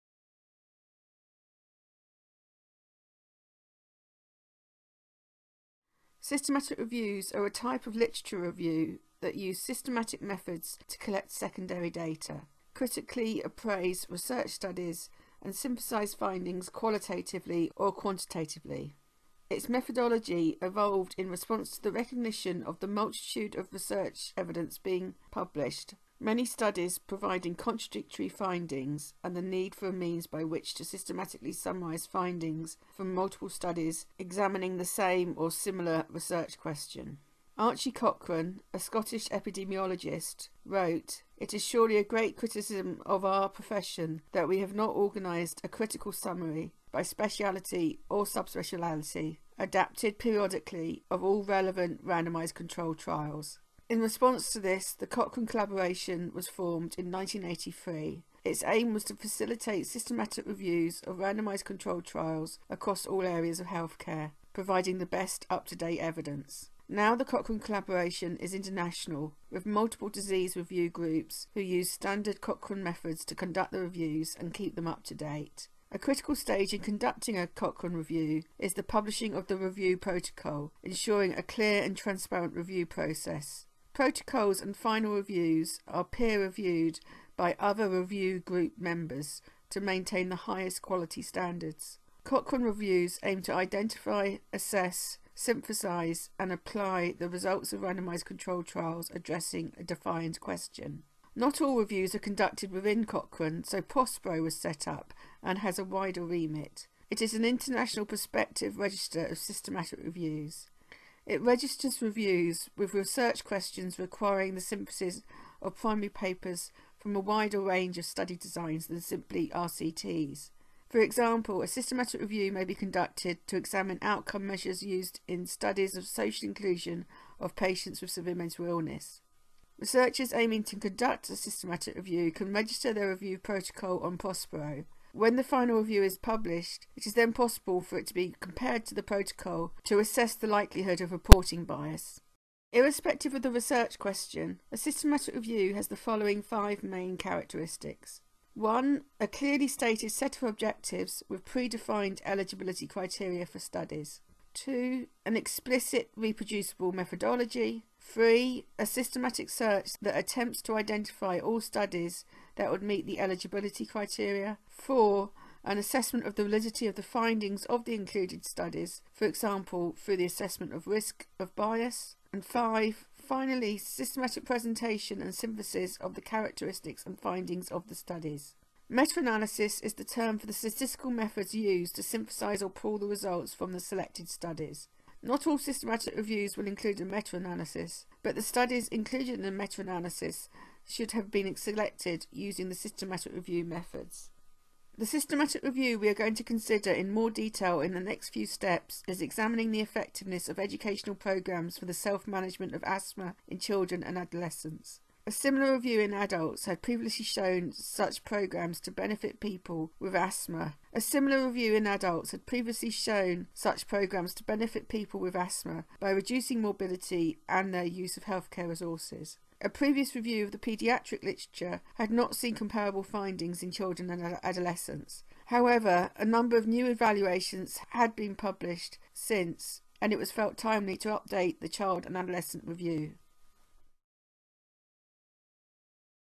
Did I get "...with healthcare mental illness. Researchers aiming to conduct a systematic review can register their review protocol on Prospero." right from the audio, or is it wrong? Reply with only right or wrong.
wrong.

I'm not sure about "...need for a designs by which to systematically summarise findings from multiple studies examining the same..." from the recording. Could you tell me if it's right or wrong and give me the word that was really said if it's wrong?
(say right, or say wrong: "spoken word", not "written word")
wrong: "means", not "designs".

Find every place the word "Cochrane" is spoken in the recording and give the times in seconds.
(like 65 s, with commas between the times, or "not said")
37 s, 55 s, 67 s, 72 s, 77 s, 92 s, 103 s.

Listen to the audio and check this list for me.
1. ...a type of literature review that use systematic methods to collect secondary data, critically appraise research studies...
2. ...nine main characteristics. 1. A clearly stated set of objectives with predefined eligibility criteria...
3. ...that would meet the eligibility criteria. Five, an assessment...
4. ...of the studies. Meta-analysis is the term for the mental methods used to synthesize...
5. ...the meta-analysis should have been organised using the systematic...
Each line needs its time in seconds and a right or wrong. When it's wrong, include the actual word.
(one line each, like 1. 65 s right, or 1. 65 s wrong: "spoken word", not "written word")
1. 7 s right
2. 146 s wrong: "five", not "nine"
3. 162 s wrong: "Four", not "Five"
4. 177 s wrong: "statistical", not "mental"
5. 189 s wrong: "selected", not "organised".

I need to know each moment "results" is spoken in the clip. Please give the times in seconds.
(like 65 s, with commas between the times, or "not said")
97 s, 183 s.